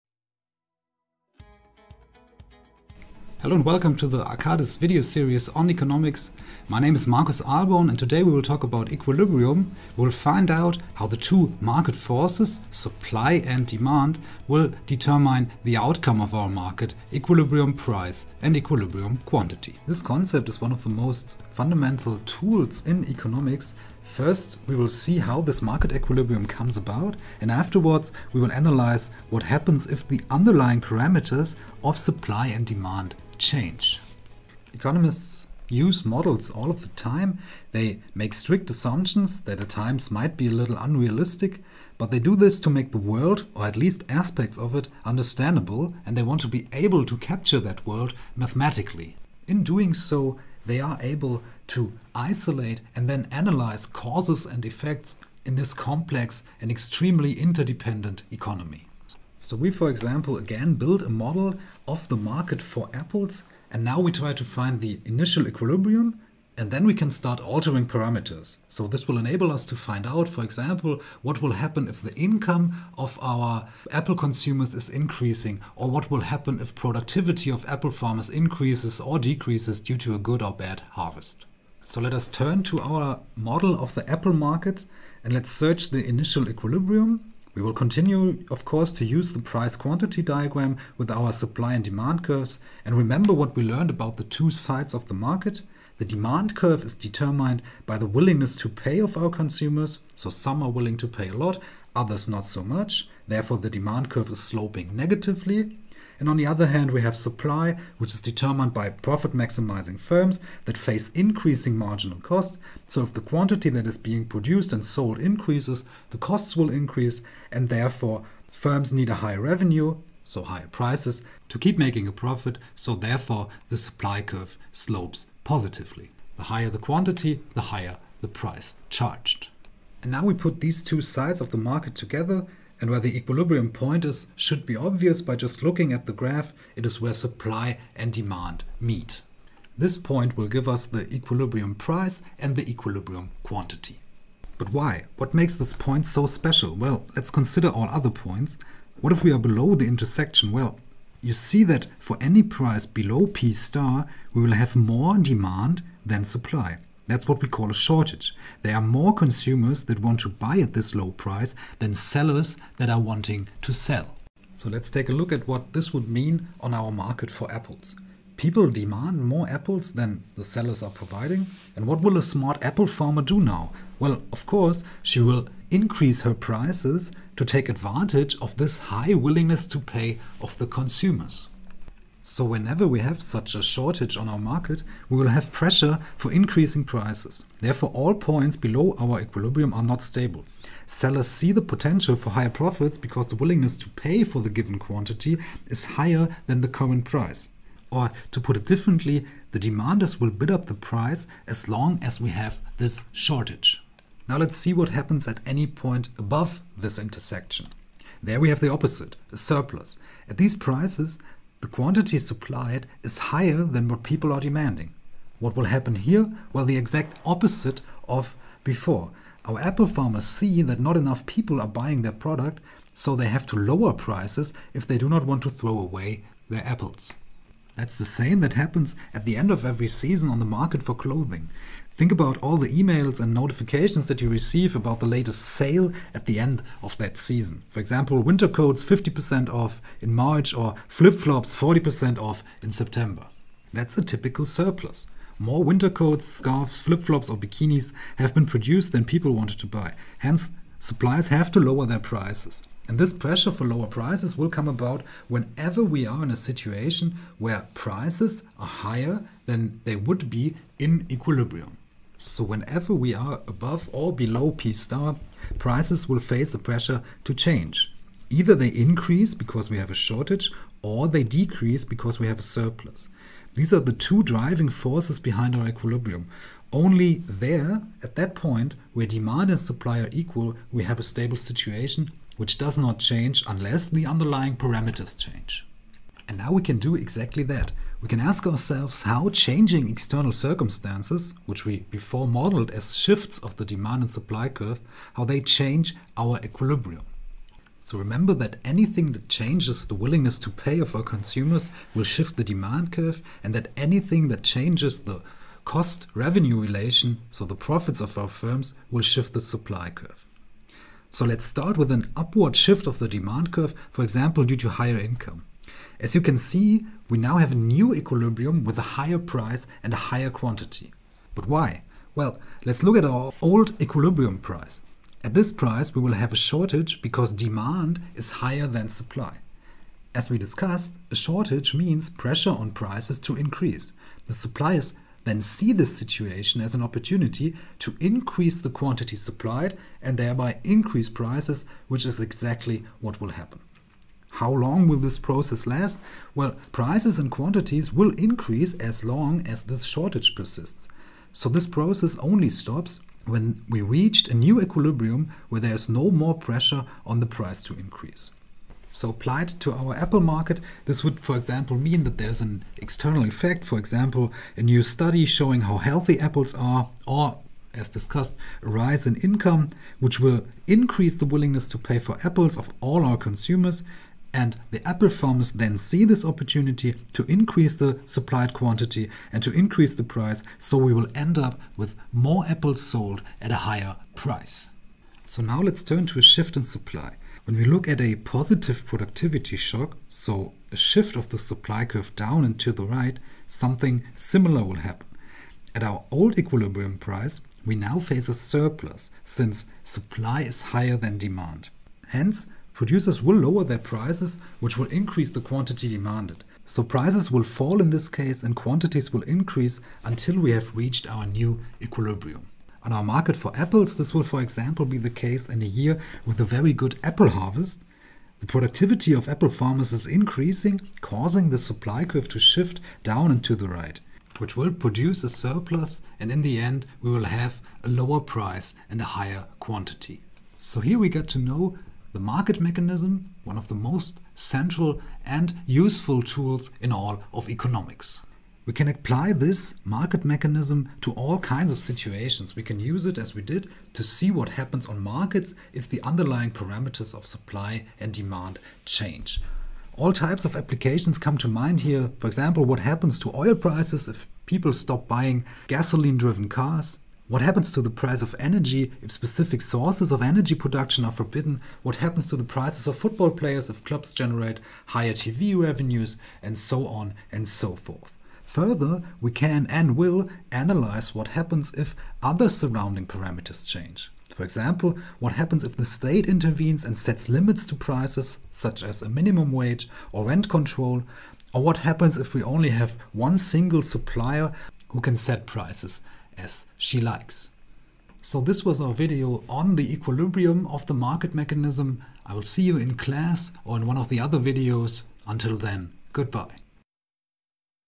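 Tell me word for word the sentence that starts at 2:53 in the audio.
Well, of course, she will increase her prices to take advantage of this high willingness to pay of the consumers.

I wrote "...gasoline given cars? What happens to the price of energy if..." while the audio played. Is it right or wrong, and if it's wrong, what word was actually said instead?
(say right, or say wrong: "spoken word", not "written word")
wrong: "driven", not "given".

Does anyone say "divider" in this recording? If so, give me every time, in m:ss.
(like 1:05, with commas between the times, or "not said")
not said.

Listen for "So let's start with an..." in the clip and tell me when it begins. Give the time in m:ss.
5:11.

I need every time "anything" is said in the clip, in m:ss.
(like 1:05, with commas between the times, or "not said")
4:58, 5:03.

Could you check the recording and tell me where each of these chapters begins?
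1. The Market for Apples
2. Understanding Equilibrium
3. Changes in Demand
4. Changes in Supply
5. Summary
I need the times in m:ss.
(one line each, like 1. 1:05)
1. 1:00
2. 2:12
3. 4:46
4. 6:24
5. 7:08.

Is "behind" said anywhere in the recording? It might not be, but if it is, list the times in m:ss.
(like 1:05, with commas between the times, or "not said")
4:35.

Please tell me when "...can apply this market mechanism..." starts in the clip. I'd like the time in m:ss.
7:18.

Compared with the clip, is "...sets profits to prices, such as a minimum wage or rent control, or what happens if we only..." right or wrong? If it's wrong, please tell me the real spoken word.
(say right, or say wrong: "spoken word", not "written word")
wrong: "limits", not "profits".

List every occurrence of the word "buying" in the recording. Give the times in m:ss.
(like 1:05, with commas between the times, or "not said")
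3:41, 7:35.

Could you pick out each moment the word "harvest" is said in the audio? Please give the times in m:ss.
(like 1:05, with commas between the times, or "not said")
1:20, 6:57.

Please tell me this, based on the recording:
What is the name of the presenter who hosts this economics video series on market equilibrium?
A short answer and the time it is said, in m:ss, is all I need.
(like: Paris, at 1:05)
Marcus Alborn, at 0:07.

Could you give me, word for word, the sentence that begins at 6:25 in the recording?
So now let's turn to a shift in supply.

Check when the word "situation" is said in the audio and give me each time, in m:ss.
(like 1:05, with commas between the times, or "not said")
4:16, 4:41, 5:35, 7:21.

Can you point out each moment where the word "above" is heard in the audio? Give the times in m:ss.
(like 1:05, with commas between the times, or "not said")
3:26, 4:23.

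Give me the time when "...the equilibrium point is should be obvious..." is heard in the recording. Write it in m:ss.
2:12.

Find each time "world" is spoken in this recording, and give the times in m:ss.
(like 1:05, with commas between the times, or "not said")
0:42, 0:47.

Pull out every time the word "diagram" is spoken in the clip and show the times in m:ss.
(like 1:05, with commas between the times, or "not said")
1:30.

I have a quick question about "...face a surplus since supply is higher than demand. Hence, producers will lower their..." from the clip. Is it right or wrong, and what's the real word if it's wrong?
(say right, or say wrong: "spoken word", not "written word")
right.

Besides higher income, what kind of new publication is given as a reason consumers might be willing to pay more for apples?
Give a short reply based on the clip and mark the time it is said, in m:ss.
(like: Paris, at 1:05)
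A new study, at 6:04.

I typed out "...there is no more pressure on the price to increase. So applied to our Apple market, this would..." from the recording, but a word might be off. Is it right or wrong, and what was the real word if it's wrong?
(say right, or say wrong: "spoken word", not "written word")
right.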